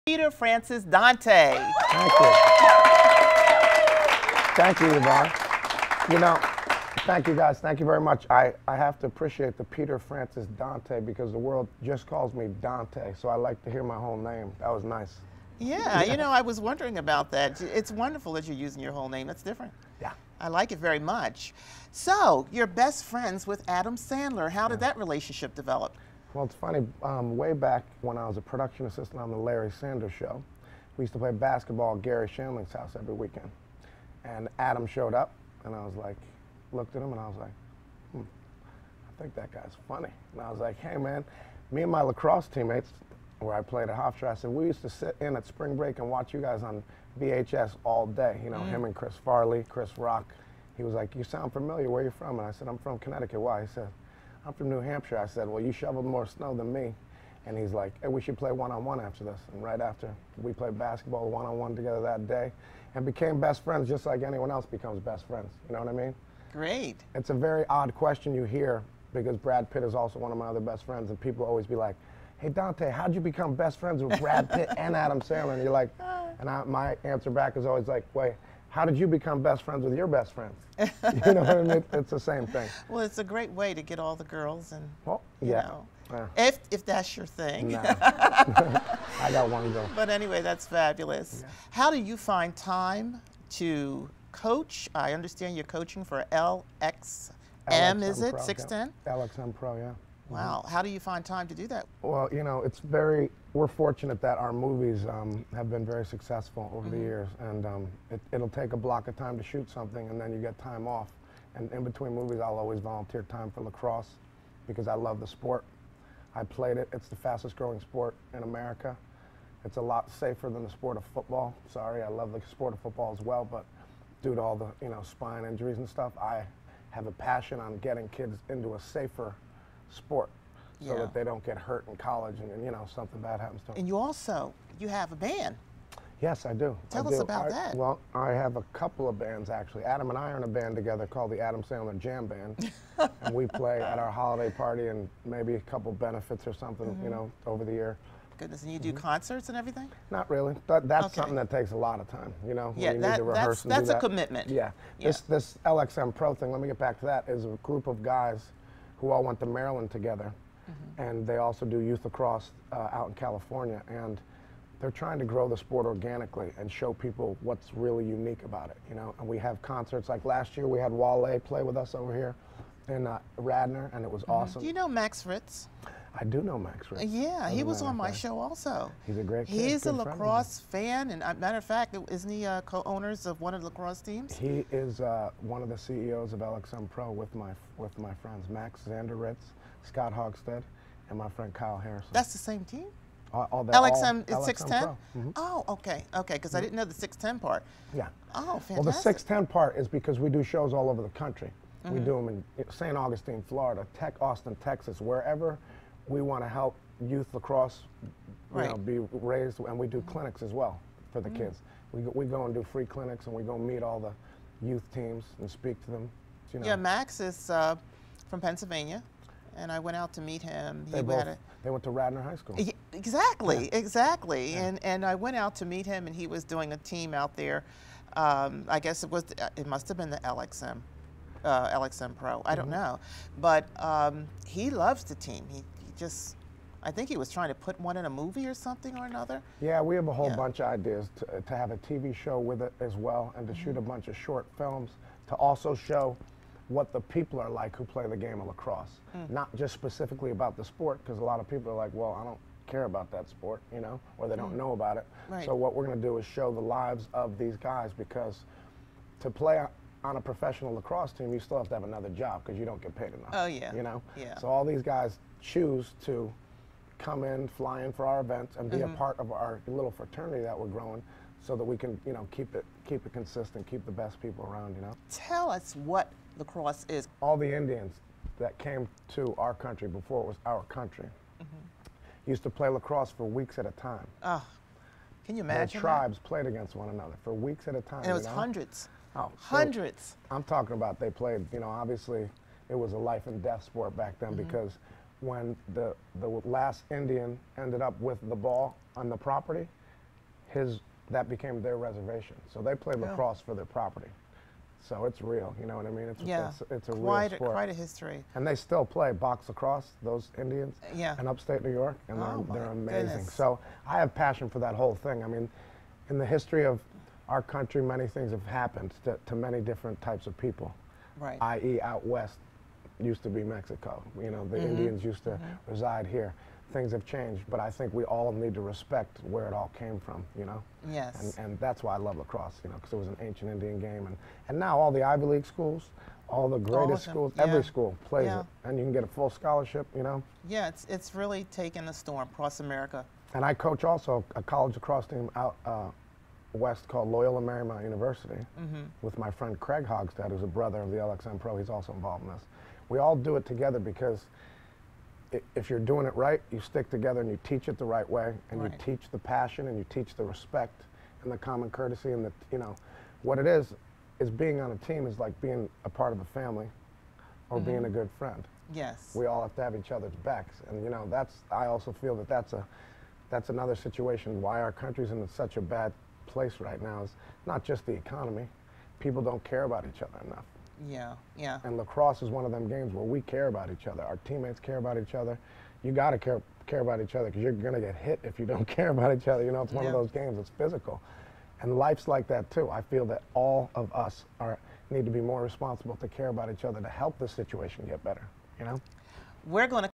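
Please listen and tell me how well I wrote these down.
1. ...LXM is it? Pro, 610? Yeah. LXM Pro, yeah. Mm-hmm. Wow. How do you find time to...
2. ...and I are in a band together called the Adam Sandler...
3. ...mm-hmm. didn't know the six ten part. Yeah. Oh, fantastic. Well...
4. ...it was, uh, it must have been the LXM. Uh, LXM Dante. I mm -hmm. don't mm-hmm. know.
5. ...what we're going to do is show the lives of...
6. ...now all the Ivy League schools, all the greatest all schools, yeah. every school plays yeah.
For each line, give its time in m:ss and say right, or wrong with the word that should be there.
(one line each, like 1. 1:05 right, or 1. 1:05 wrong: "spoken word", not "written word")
1. 1:37 right
2. 2:20 right
3. 3:16 right
4. 3:49 wrong: "Pro", not "Dante"
5. 4:15 right
6. 5:34 right.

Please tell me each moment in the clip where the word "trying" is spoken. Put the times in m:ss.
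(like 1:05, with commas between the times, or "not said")
2:44, 3:57.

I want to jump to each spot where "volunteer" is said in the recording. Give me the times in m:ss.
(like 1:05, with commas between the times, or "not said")
1:52.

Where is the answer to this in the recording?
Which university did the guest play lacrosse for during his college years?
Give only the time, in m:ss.
0:43.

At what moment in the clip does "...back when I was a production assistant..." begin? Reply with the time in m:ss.
0:27.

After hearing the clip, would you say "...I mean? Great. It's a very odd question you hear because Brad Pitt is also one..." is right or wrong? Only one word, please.
right.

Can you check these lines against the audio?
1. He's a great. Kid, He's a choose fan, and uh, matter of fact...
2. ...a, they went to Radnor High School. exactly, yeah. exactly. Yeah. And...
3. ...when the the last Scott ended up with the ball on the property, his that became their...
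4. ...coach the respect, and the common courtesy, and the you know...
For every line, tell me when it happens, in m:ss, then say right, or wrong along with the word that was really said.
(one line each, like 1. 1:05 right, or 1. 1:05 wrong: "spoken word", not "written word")
1. 2:59 wrong: "lacrosse", not "choose"
2. 3:41 right
3. 4:55 wrong: "Indian", not "Scott"
4. 5:59 wrong: "teach", not "coach".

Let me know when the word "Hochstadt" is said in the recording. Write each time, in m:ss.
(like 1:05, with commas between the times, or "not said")
3:10, 5:49.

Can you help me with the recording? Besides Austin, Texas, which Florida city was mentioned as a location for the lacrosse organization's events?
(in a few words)
St. Augustine.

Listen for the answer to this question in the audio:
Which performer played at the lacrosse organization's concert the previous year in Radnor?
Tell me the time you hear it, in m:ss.
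2:50.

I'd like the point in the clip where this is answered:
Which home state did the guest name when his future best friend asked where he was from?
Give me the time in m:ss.
0:52.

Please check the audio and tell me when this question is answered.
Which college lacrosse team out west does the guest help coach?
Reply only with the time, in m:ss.
5:47.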